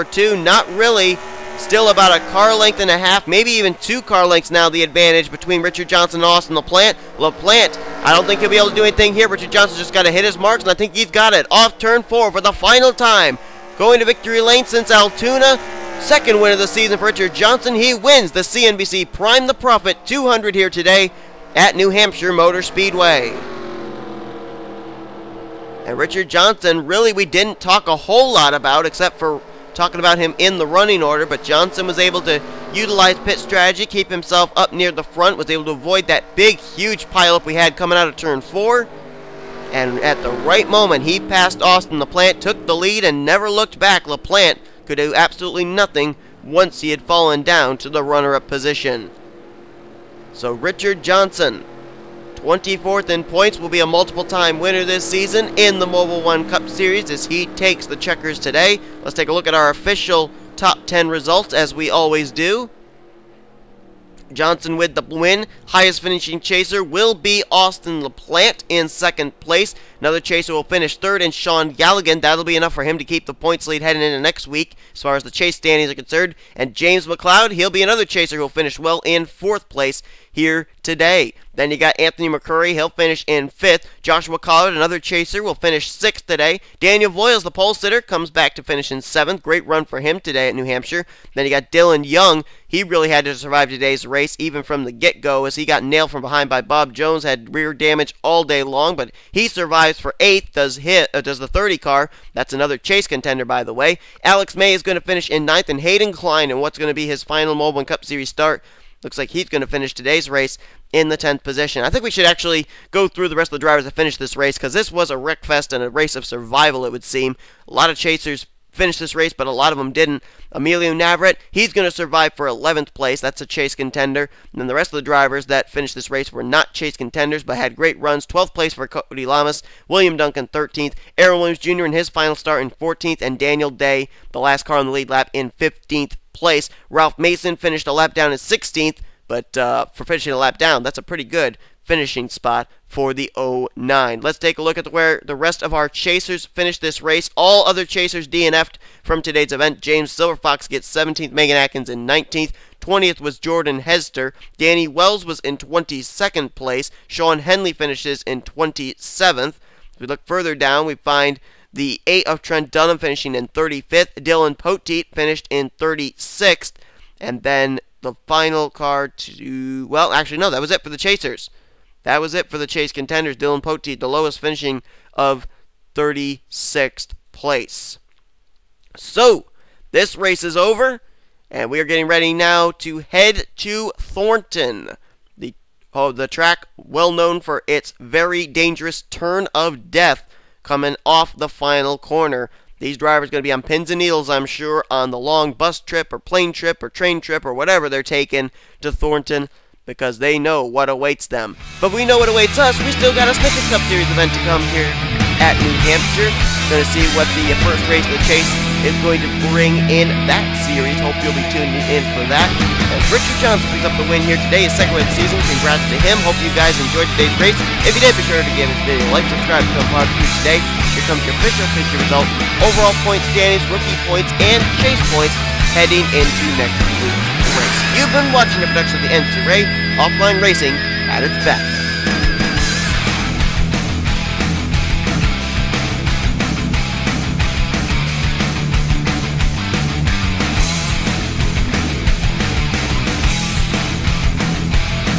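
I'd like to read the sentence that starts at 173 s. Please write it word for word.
Dylan Poteet, the lowest finishing of 36th place.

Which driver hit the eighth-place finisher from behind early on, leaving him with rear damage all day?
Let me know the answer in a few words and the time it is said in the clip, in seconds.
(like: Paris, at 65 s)
Bob Jones, at 96 s.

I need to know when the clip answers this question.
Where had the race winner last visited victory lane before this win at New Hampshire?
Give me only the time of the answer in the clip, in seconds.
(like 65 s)
14 s.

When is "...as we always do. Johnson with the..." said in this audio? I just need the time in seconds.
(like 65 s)
61 s.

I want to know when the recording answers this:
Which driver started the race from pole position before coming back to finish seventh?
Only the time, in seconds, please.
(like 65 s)
86 s.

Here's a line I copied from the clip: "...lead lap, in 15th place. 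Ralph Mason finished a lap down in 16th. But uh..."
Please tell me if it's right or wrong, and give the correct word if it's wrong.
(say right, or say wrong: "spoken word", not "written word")
right.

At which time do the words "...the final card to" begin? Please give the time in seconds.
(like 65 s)
168 s.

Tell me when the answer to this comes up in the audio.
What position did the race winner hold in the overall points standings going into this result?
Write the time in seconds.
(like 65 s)
52 s.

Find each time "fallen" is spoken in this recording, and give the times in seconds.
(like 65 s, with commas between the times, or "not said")
47 s.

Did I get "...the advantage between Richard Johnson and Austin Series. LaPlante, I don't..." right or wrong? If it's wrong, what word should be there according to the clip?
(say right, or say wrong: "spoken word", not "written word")
wrong: "LaPlante", not "Series".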